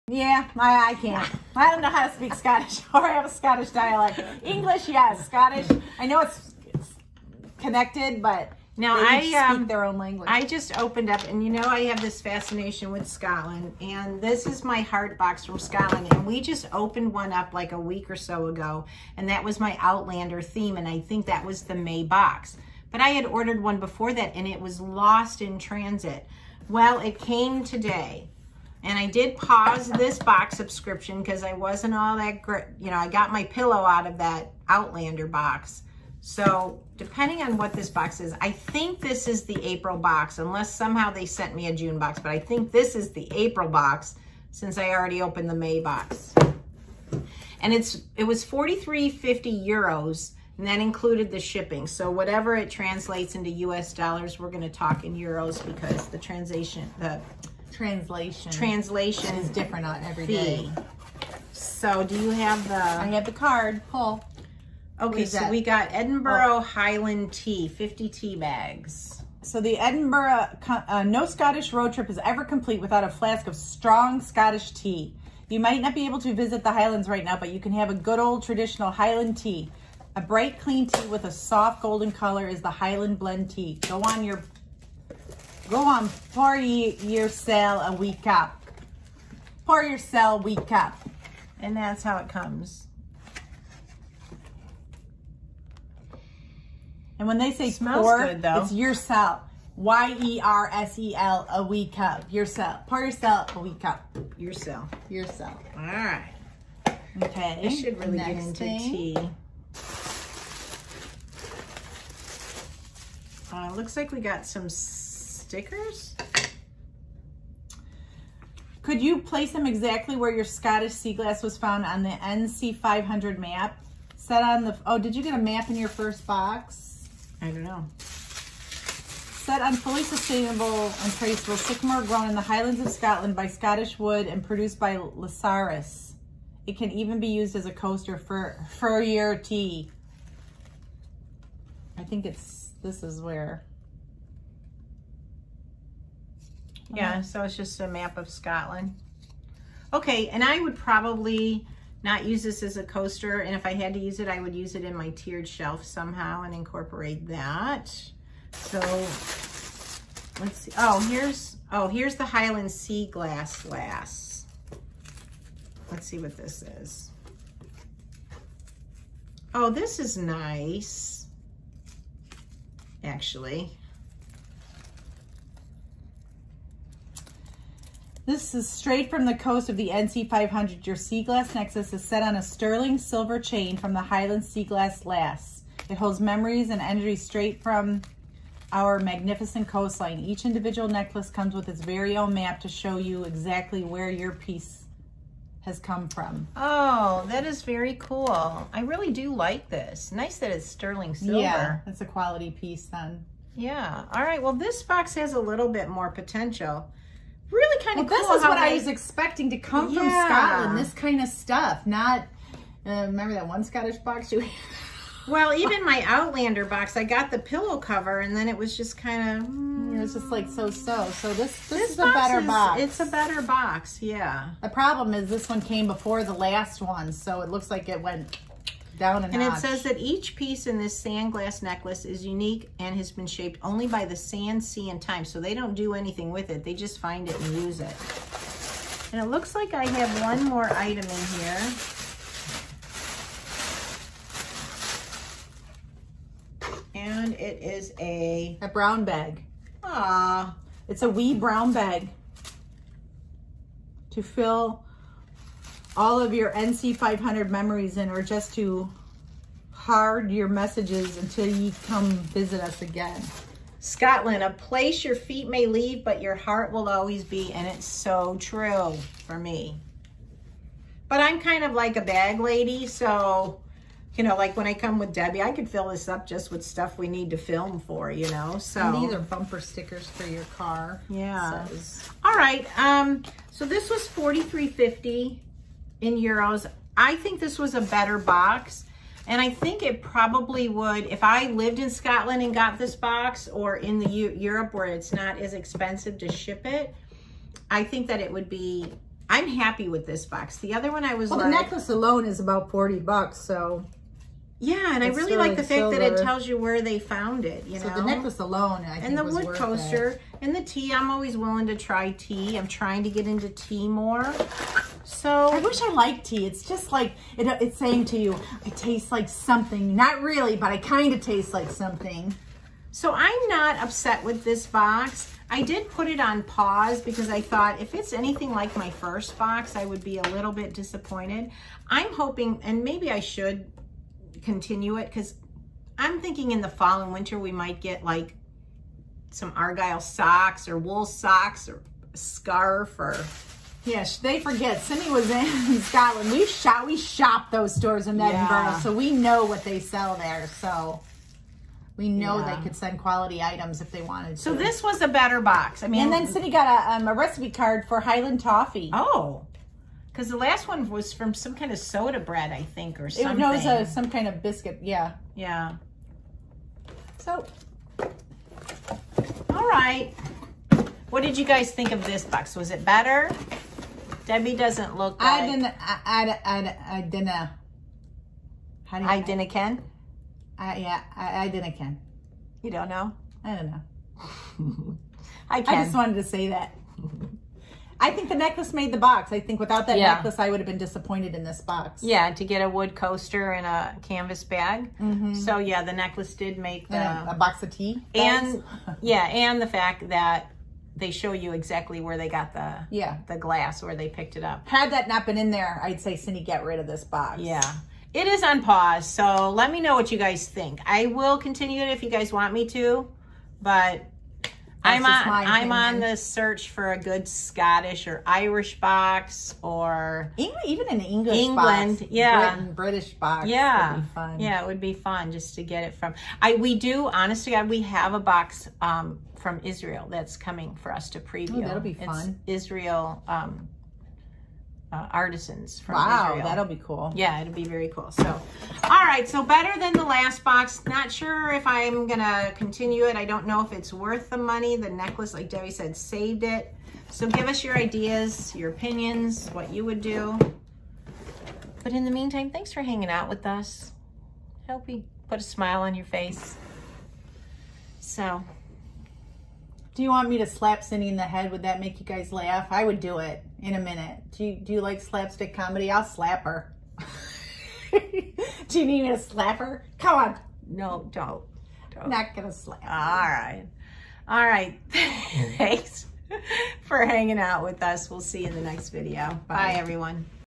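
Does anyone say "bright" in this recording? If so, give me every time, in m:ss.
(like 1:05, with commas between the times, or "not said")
1:20.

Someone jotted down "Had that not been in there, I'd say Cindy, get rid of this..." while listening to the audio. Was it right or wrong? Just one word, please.
right.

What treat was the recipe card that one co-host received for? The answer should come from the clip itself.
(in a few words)
Highland Toffee.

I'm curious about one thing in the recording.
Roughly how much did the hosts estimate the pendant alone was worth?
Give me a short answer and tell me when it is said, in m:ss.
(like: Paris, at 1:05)
about 40 bucks, at 5:02.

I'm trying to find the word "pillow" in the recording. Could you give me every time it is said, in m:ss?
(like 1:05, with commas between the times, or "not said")
0:33, 3:37.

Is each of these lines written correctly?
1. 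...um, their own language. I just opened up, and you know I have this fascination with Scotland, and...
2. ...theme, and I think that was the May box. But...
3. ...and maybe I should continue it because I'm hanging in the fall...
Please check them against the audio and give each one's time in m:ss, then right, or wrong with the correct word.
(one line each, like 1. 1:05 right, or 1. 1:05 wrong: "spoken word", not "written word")
1. 0:09 right
2. 0:20 right
3. 5:32 wrong: "thinking", not "hanging".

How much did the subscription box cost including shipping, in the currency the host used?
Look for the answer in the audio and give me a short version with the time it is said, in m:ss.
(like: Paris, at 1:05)
43.50 euros, at 0:48.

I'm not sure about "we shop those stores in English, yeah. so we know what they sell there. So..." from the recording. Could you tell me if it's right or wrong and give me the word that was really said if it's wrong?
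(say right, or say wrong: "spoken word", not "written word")
wrong: "Edinburgh", not "English".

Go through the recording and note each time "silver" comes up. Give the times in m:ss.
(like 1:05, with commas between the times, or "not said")
3:02, 3:21, 5:05.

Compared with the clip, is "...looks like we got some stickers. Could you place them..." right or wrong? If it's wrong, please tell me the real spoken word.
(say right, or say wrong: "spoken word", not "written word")
right.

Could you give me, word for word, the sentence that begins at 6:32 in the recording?
Yeah, to get a wood coaster and a canvas bag.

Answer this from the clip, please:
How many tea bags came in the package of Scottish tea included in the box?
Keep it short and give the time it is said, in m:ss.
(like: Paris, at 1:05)
50, at 1:07.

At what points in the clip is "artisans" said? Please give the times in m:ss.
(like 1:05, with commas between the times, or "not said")
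7:15.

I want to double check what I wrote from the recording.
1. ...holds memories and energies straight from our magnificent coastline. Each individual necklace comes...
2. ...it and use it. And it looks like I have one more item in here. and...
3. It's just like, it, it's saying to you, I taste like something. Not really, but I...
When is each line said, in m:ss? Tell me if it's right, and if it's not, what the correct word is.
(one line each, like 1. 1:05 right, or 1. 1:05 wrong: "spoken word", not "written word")
1. 3:05 right
2. 3:57 right
3. 5:16 right.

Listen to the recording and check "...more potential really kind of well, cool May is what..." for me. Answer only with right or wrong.
wrong.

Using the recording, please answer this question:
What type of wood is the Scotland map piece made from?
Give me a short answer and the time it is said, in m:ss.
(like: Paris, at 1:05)
sycamore, at 2:11.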